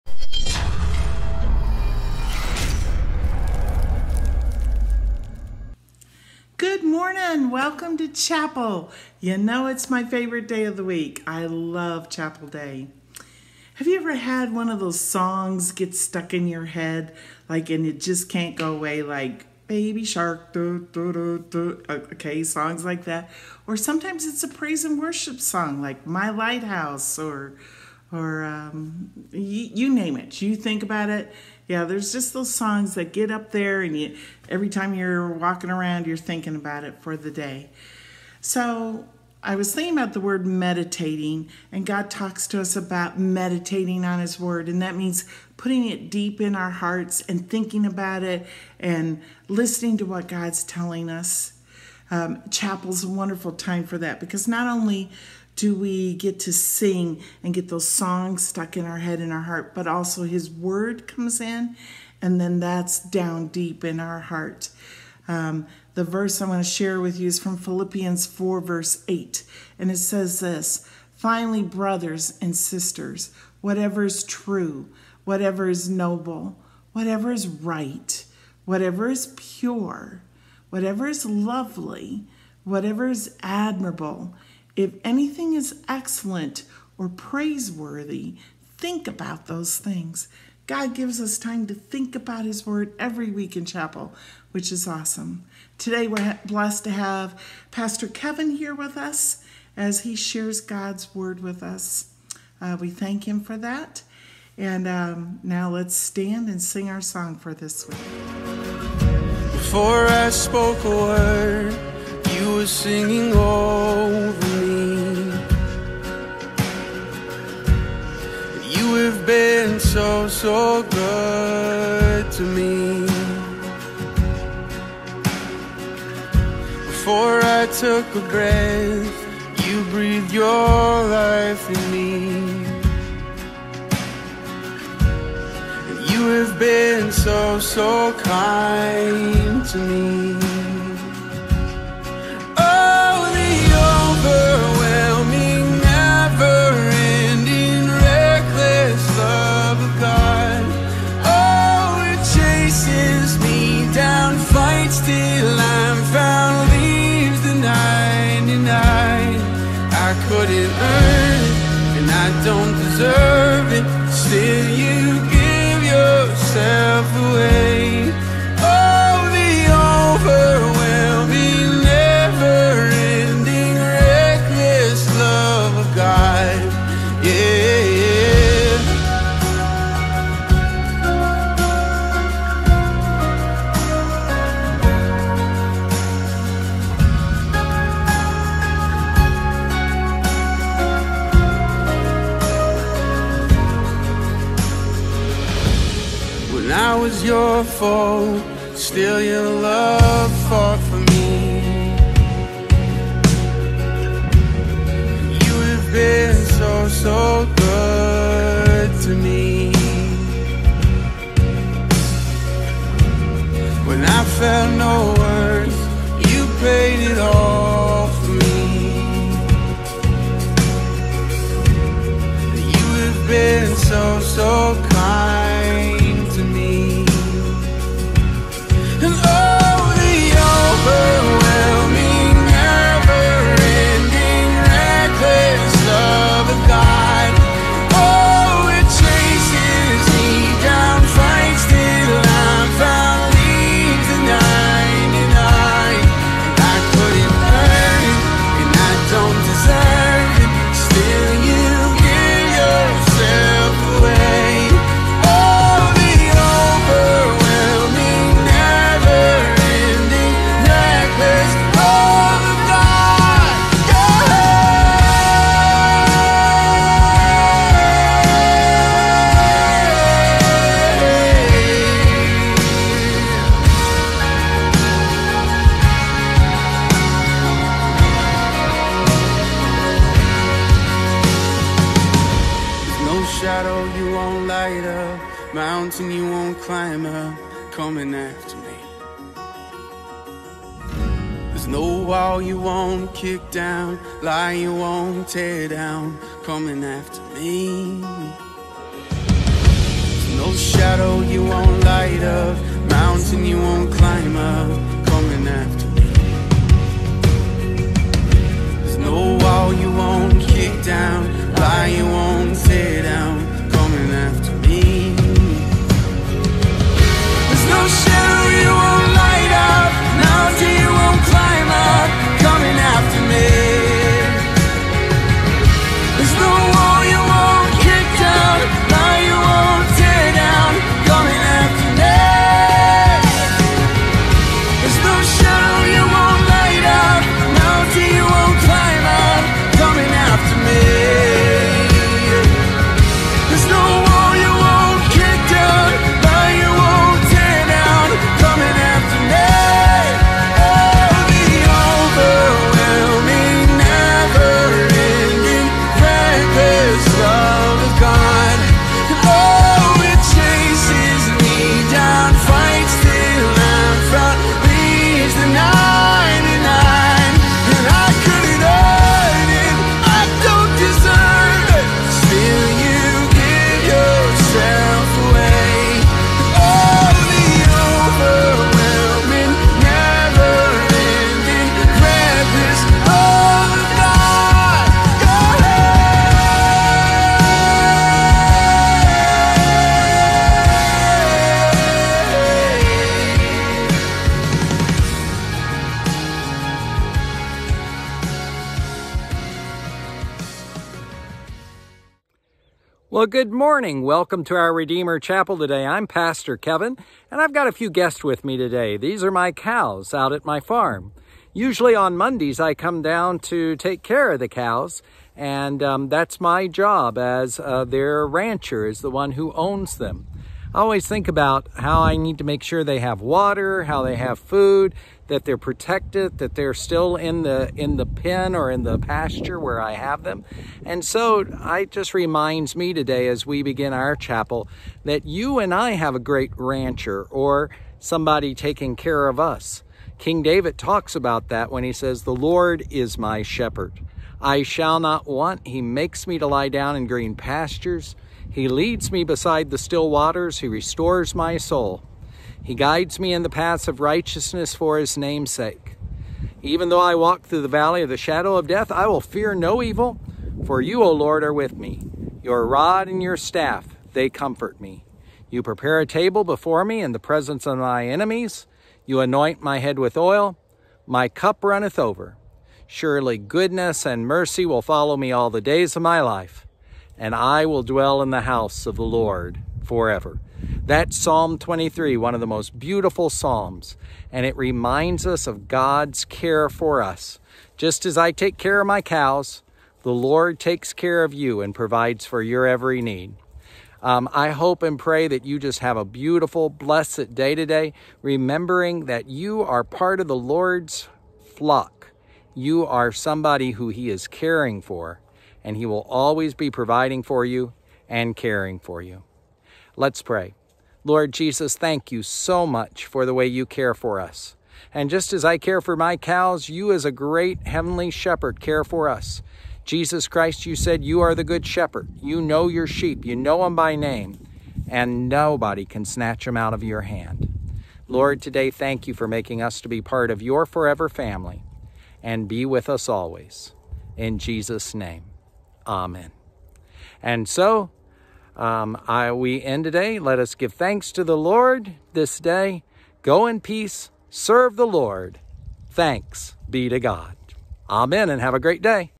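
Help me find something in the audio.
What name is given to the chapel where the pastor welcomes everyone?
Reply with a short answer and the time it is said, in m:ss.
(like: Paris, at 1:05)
Redeemer Chapel, at 6:44.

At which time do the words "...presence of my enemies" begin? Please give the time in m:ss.
7:47.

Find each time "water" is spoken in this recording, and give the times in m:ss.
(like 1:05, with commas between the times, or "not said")
7:03, 7:30.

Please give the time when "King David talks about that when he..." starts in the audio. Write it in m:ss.
7:20.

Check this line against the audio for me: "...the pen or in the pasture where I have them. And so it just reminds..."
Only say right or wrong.
right.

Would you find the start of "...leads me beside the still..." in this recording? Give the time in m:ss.
7:28.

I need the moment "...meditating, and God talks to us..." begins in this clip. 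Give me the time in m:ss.
0:40.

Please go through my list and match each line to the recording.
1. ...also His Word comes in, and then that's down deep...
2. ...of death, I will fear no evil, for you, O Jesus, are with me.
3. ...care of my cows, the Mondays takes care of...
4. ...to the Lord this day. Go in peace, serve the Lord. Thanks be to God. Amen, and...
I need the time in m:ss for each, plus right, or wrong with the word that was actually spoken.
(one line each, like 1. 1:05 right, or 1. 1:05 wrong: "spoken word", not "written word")
1. 0:59 right
2. 7:38 wrong: "Lord", not "Jesus"
3. 8:08 wrong: "Lord", not "Mondays"
4. 9:01 right.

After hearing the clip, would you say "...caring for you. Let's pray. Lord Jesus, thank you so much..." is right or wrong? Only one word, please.
right.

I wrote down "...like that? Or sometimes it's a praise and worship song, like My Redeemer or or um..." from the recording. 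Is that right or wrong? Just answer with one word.
wrong.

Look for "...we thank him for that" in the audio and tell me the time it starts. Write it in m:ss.
1:42.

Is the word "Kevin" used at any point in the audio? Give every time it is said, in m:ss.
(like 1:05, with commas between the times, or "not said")
1:38, 6:46.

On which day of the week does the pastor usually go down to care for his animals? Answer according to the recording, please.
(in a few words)
Mondays.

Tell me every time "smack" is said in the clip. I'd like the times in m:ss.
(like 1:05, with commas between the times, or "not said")
not said.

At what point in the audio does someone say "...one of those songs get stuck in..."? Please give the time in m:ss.
0:14.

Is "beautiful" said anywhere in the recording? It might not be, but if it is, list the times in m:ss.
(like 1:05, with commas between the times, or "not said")
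8:02, 8:16.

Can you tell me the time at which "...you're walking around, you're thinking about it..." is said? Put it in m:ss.
0:34.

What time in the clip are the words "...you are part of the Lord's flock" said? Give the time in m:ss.
8:19.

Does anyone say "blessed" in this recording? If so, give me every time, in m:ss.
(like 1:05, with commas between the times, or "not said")
1:36, 8:16.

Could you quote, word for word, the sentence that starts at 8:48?
Lord, today, thank you for making us to be part of your forever family and be with us always.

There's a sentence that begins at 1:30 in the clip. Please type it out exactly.
God gives us time to think about His Word every week in chapel, which is awesome.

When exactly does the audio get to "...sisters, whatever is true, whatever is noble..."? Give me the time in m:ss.
1:12.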